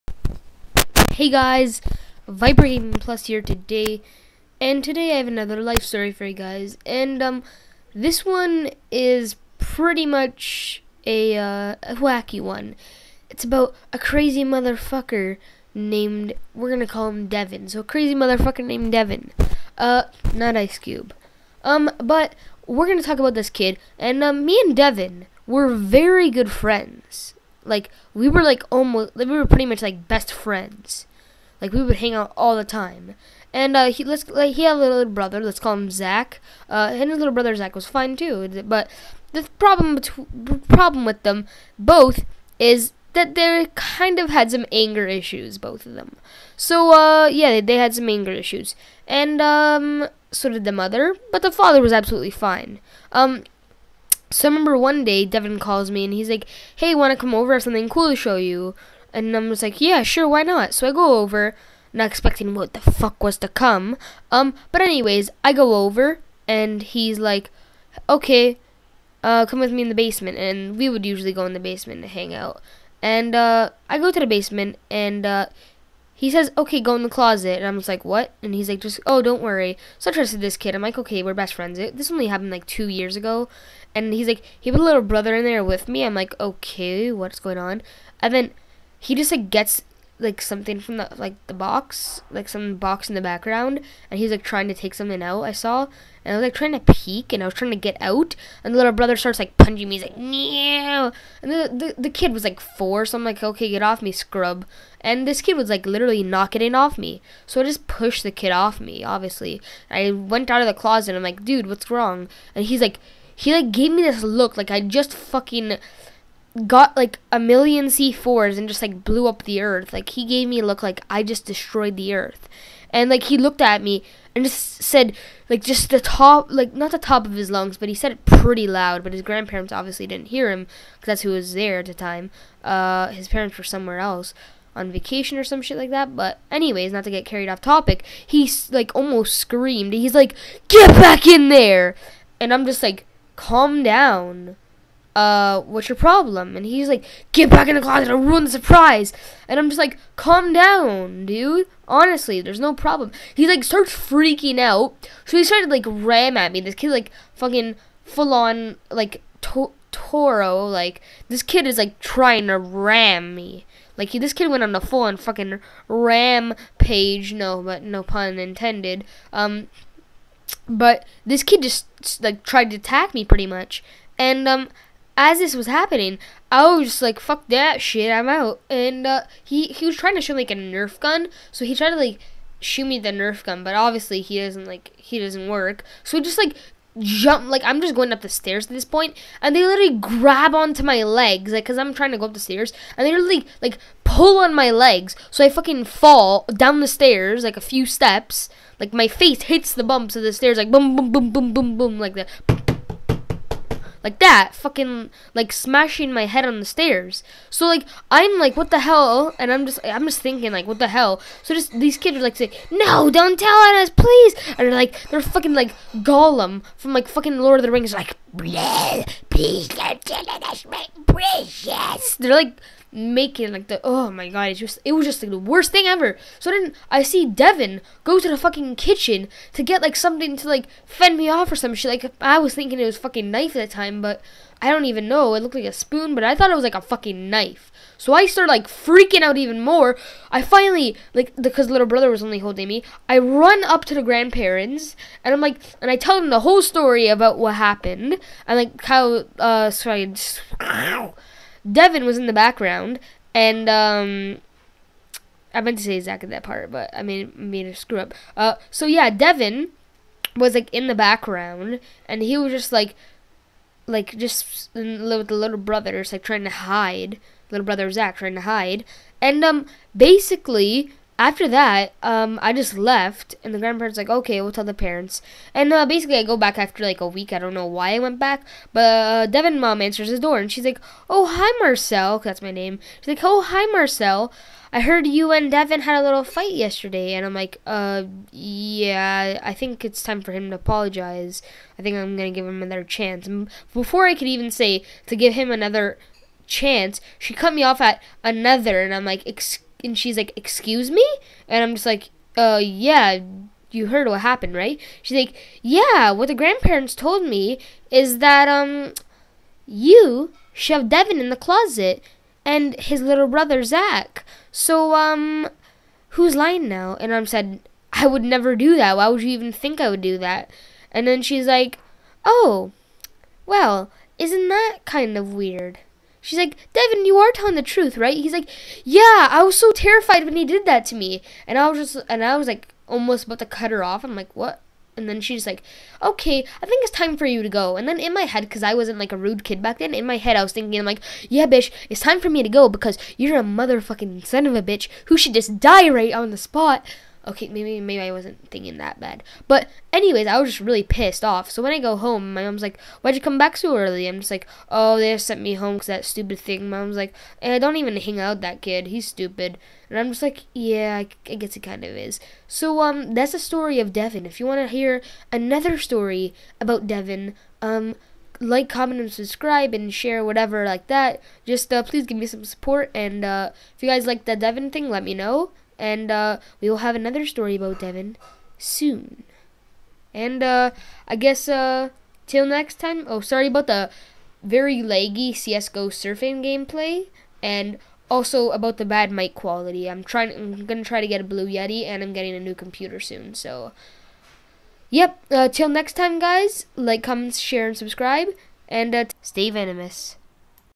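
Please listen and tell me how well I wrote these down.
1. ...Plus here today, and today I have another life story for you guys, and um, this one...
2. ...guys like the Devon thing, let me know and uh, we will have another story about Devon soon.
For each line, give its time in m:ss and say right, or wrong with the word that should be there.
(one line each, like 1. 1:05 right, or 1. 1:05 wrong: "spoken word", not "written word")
1. 0:02 right
2. 6:13 right.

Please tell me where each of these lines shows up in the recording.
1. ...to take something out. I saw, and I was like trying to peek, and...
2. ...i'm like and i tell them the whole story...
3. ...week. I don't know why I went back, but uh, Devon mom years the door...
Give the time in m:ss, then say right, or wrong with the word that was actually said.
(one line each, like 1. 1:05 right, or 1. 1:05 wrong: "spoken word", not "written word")
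1. 1:34 right
2. 4:05 right
3. 4:37 wrong: "answers", not "years".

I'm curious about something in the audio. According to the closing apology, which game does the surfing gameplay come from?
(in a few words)
CS:GO.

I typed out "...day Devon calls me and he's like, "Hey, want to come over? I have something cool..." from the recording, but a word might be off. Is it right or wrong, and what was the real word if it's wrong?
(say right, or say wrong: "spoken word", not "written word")
right.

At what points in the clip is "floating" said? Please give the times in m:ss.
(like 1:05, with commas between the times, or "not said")
not said.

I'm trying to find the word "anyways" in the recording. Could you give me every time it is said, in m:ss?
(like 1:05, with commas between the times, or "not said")
1:04, 2:16, 5:49.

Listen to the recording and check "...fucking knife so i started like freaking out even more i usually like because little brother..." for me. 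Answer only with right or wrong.
wrong.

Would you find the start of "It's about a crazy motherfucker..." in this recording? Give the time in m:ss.
0:13.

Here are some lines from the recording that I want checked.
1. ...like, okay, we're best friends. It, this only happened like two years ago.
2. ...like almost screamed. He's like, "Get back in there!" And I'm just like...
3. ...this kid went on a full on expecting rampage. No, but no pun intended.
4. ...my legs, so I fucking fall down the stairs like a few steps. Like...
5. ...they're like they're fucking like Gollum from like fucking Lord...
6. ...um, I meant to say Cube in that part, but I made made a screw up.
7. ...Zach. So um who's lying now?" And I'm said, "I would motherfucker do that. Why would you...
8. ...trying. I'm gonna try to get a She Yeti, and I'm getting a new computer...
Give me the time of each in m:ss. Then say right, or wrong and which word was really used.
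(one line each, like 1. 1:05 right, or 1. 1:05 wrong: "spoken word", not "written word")
1. 1:20 right
2. 2:18 right
3. 2:44 wrong: "fucking", not "expecting"
4. 3:14 right
5. 3:34 right
6. 4:13 wrong: "Zach", not "Cube"
7. 5:13 wrong: "never", not "motherfucker"
8. 6:30 wrong: "Blue", not "She".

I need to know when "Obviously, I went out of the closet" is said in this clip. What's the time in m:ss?
1:49.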